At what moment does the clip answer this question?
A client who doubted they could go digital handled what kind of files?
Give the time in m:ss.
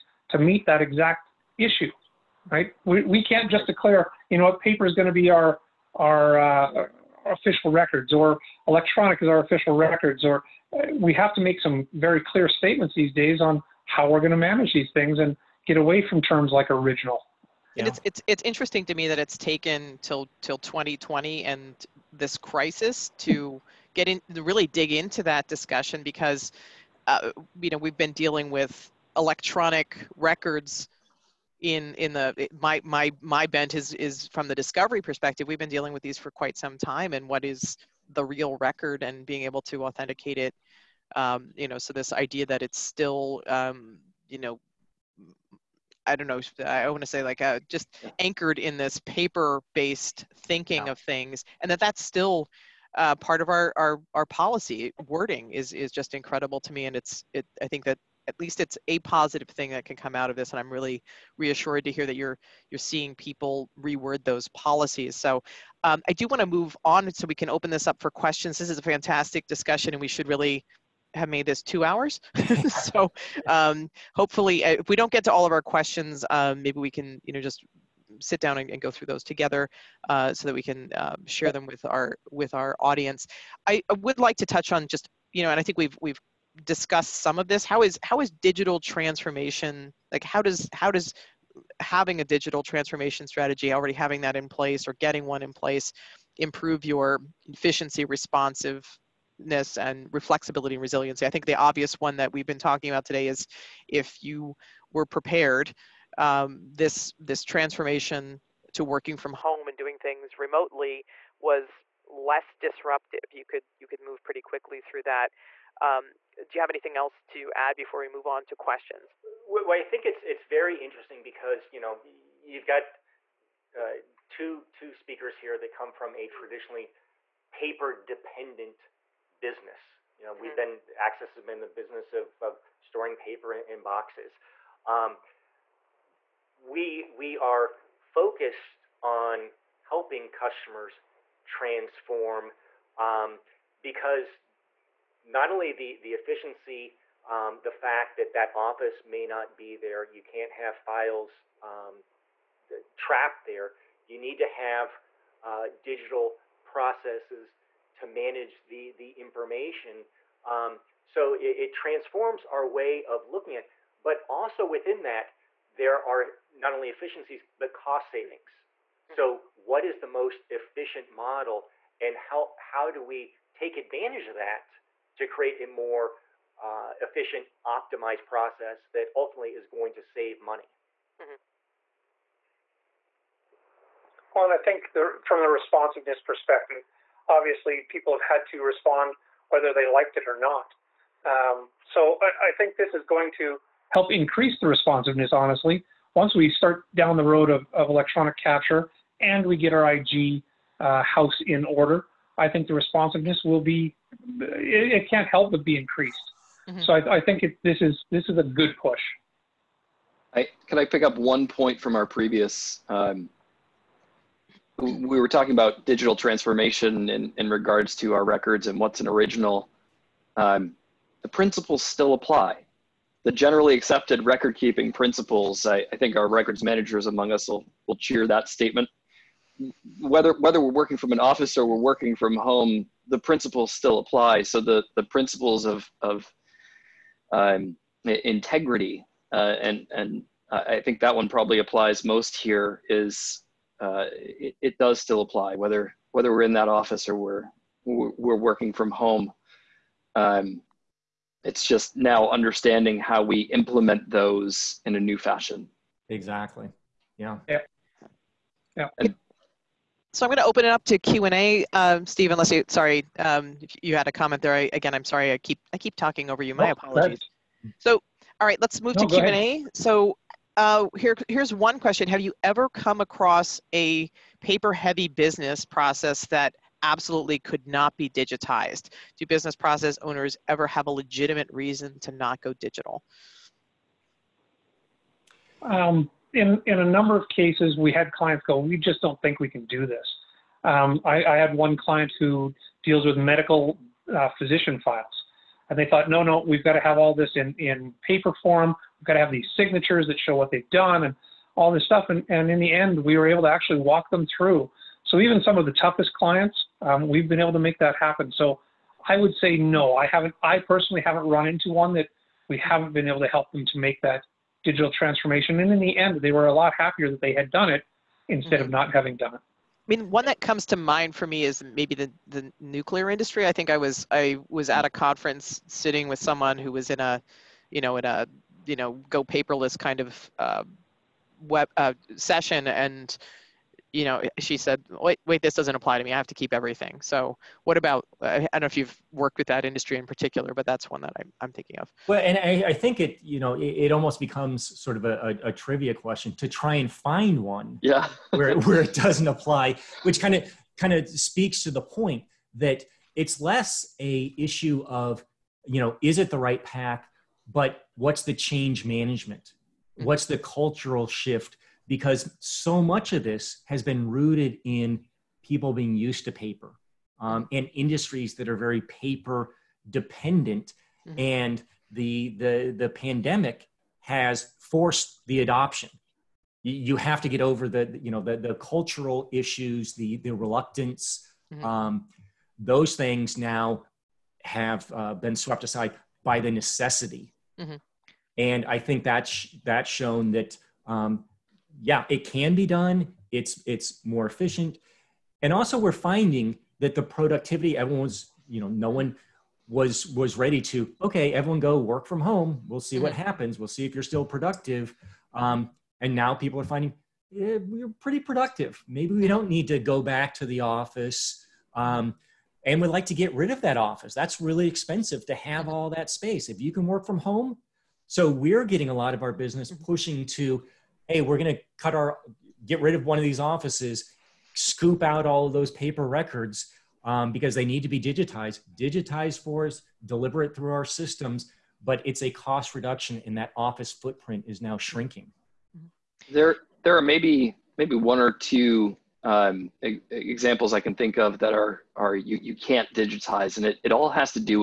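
4:54.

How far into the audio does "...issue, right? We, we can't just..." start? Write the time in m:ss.
0:01.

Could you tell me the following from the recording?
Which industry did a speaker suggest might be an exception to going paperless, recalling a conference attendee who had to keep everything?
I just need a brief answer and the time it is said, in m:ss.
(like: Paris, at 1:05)
nuclear industry, at 5:22.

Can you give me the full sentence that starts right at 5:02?
And, and in the end, we were able to actually walk them through.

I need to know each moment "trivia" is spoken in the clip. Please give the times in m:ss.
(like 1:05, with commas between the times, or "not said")
5:45.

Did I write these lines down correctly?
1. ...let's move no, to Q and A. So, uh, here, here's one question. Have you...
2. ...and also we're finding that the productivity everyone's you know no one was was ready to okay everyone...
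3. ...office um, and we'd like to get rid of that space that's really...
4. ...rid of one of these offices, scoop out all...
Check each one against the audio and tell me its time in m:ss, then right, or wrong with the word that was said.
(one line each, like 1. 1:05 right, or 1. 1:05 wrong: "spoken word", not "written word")
1. 4:28 right
2. 6:35 right
3. 6:50 wrong: "office", not "space"
4. 7:02 right.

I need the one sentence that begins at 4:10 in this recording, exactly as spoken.
Um, it's just now understanding how we implement those in a new fashion.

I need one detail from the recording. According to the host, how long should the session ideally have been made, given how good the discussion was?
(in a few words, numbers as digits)
2 hours.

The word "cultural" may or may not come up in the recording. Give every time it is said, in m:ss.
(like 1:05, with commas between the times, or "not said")
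6:00, 6:18.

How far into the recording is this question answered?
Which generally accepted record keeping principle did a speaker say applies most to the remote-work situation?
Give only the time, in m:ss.
3:58.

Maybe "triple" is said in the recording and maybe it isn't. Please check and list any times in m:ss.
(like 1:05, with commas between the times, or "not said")
not said.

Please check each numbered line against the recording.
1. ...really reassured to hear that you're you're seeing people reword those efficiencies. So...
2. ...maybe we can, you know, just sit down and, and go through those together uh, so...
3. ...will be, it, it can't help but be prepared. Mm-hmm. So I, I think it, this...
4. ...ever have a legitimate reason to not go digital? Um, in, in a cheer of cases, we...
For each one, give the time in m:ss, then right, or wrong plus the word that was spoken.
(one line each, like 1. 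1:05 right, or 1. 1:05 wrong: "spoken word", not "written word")
1. 1:00 wrong: "policies", not "efficiencies"
2. 1:16 right
3. 3:23 wrong: "increased", not "prepared"
4. 4:40 wrong: "number", not "cheer".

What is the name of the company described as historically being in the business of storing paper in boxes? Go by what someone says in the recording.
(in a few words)
Access.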